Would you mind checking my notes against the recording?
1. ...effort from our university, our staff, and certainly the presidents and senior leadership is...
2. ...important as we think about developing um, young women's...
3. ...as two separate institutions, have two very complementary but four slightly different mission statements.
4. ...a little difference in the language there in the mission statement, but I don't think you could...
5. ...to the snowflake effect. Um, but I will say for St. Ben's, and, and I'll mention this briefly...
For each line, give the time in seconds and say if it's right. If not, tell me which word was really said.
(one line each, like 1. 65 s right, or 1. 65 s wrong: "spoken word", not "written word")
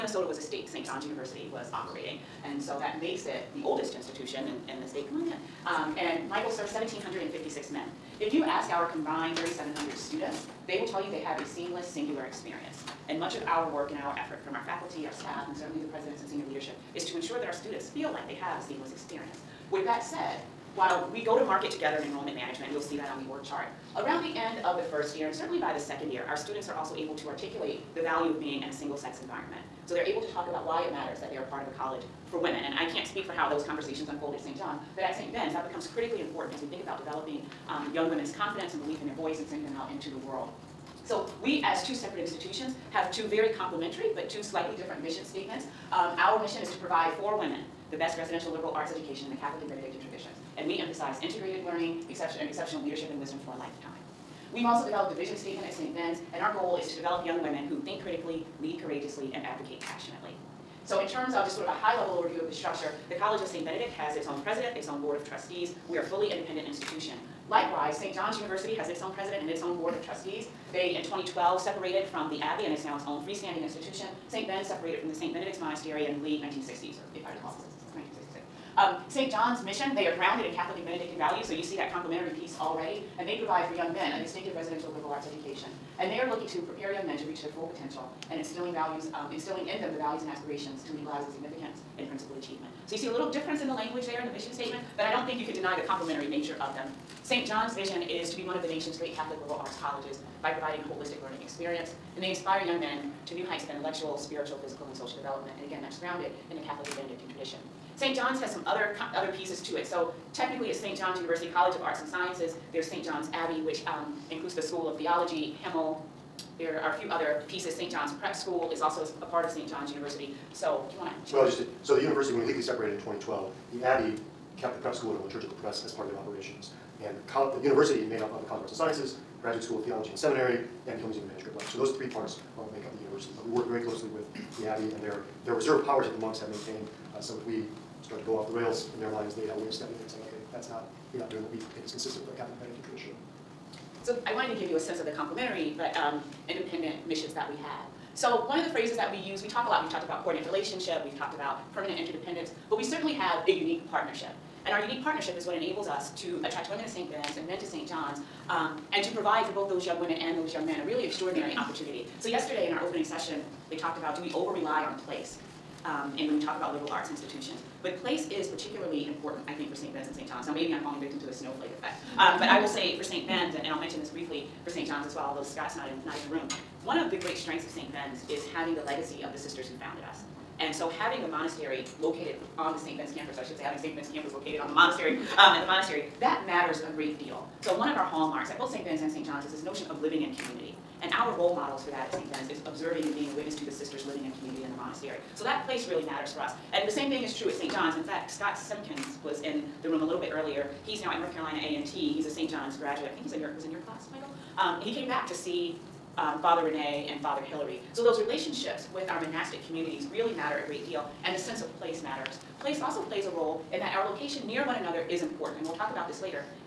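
1. 14 s wrong: "faculty", not "university"
2. 36 s right
3. 41 s wrong: "two", not "four"
4. 93 s right
5. 171 s right.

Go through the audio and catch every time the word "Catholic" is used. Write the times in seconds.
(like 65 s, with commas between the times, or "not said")
49 s, 80 s, 99 s, 106 s, 142 s.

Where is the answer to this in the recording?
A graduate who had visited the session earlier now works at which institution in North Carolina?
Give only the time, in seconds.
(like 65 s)
201 s.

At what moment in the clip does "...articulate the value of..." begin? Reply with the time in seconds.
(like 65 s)
27 s.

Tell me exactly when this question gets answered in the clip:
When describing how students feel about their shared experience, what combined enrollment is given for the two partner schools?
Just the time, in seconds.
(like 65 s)
9 s.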